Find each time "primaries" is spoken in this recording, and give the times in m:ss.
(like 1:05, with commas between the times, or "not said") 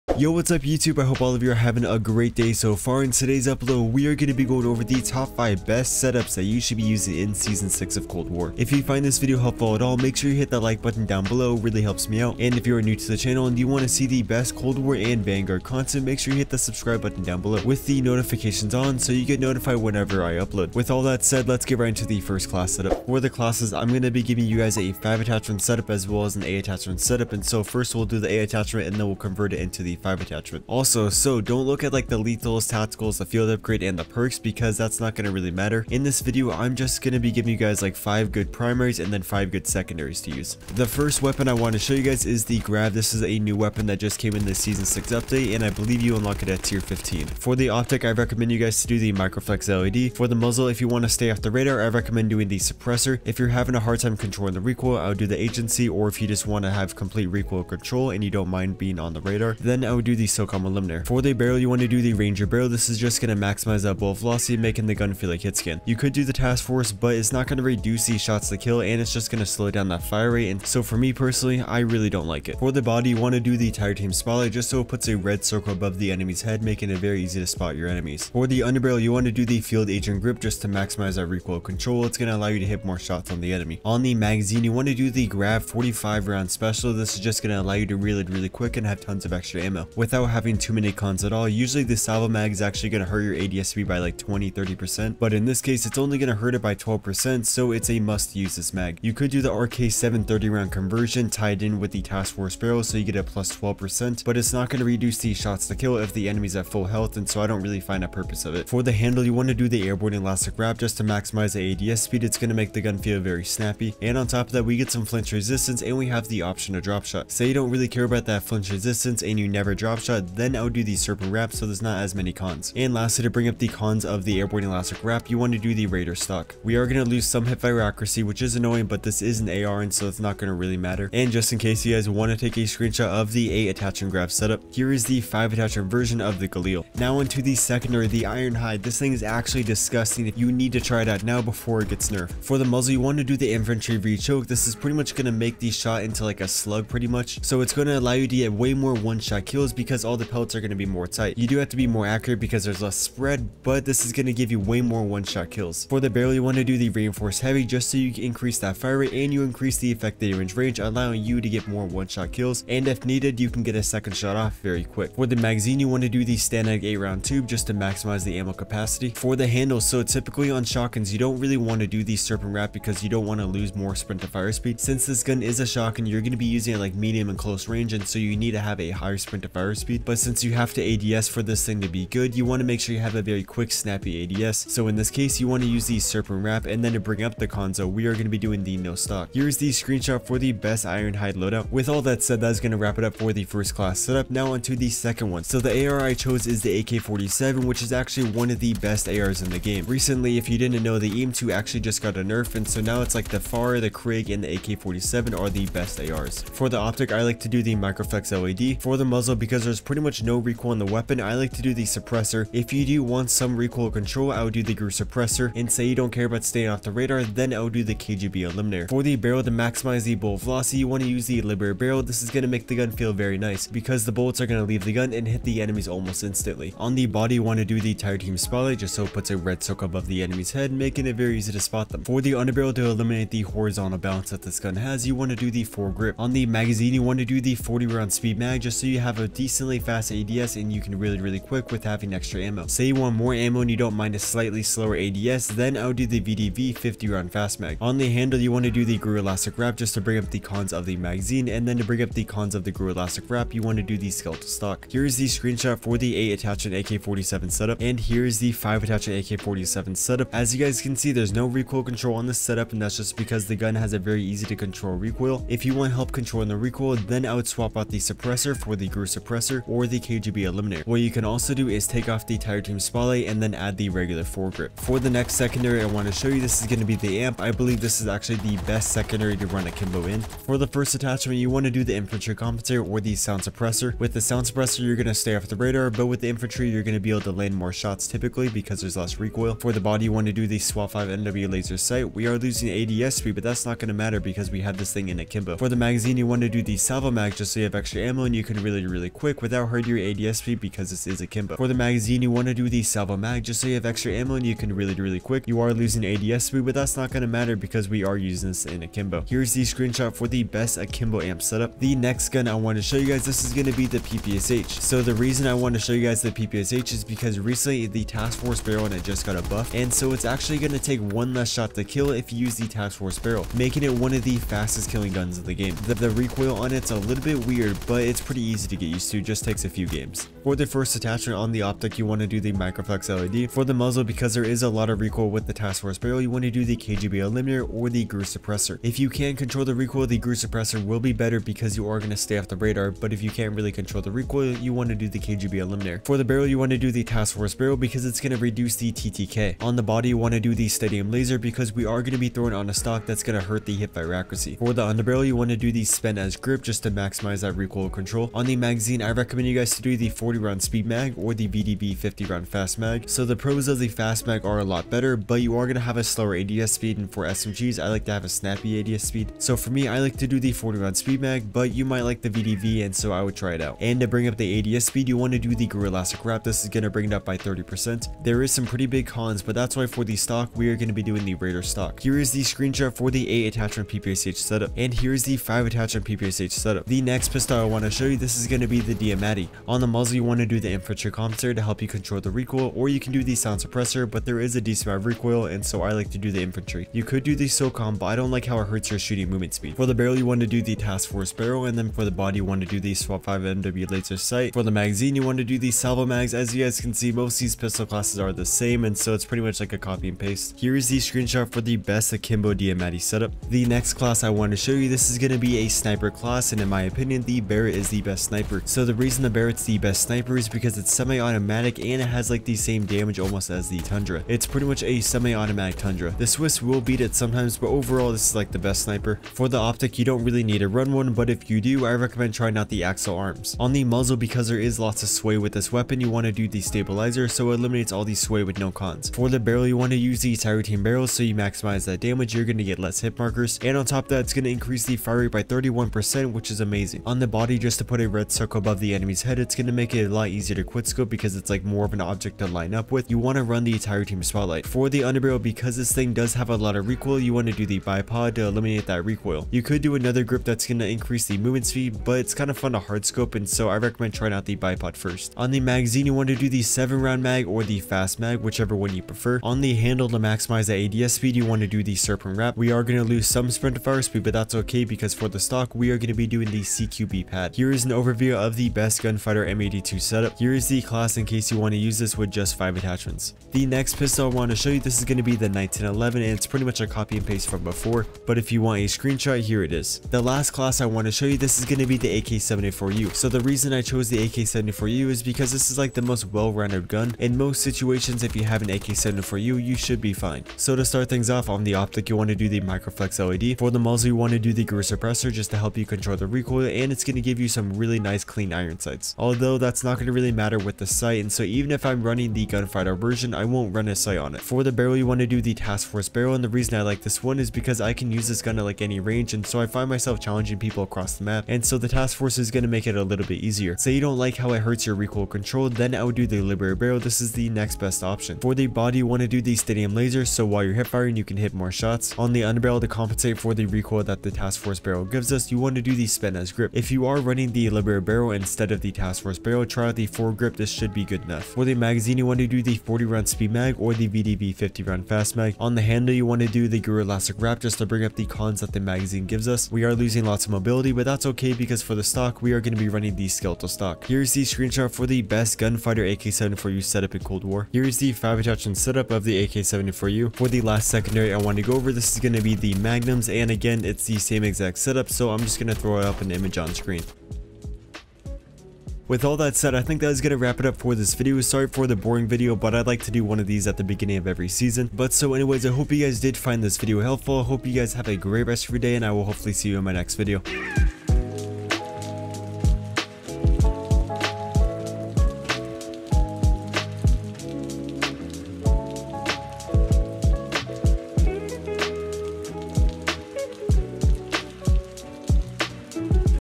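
0:38.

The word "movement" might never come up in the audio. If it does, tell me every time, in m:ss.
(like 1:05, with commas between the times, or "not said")
6:39, 7:41.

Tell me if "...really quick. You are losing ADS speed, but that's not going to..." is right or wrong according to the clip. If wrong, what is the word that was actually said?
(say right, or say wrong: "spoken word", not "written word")
right.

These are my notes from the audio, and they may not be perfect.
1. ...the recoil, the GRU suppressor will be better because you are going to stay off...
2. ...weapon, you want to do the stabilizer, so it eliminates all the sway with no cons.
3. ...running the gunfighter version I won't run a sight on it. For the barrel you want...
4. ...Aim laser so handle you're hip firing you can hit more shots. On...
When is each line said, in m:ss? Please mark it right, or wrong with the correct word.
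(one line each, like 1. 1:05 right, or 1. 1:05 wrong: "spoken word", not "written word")
1. 5:39 right
2. 7:15 right
3. 8:32 right
4. 8:49 wrong: "while", not "handle".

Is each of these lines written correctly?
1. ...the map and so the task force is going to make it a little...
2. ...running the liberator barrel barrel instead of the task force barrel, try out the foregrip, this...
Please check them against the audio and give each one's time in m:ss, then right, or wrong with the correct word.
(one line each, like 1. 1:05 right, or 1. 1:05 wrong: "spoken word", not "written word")
1. 8:41 right
2. 8:57 right.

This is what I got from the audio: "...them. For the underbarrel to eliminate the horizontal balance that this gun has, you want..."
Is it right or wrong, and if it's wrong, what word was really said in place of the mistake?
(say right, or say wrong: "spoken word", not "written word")
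right.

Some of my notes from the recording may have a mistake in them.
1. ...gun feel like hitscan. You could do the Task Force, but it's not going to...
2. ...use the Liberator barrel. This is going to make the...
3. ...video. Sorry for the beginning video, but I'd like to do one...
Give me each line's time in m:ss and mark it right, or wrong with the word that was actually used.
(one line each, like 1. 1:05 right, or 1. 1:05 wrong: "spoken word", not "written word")
1. 1:04 right
2. 3:41 right
3. 9:31 wrong: "boring", not "beginning".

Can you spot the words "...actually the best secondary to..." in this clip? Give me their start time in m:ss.
4:38.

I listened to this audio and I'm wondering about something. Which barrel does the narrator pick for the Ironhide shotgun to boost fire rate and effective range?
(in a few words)
reinforced heavy.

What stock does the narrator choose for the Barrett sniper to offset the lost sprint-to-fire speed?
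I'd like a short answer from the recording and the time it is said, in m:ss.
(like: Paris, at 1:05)
CQB pad, at 7:56.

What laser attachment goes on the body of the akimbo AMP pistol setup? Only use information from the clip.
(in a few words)
SWAT 5 NW laser sight.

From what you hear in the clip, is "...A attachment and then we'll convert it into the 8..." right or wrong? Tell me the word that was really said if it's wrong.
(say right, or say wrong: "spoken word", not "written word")
wrong: "5", not "8".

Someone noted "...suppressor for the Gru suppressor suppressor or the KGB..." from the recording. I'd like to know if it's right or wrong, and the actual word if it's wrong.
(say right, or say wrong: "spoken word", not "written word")
right.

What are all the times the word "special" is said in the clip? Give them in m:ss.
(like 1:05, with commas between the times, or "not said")
1:26.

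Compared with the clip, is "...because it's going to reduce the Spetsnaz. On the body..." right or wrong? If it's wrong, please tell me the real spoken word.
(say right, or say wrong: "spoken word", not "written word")
wrong: "TTK", not "Spetsnaz".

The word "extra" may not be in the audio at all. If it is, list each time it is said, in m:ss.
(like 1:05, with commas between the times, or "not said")
1:29, 4:02, 4:57, 5:03.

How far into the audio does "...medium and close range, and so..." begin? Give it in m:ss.
2:56.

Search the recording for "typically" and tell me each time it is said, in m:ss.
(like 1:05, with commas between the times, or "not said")
2:50, 4:48.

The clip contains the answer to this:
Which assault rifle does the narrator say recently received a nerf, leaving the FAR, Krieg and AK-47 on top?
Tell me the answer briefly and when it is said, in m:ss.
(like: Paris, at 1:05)
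EM2, at 3:21.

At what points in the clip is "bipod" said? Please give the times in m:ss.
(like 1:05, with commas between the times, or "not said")
7:37, 7:44.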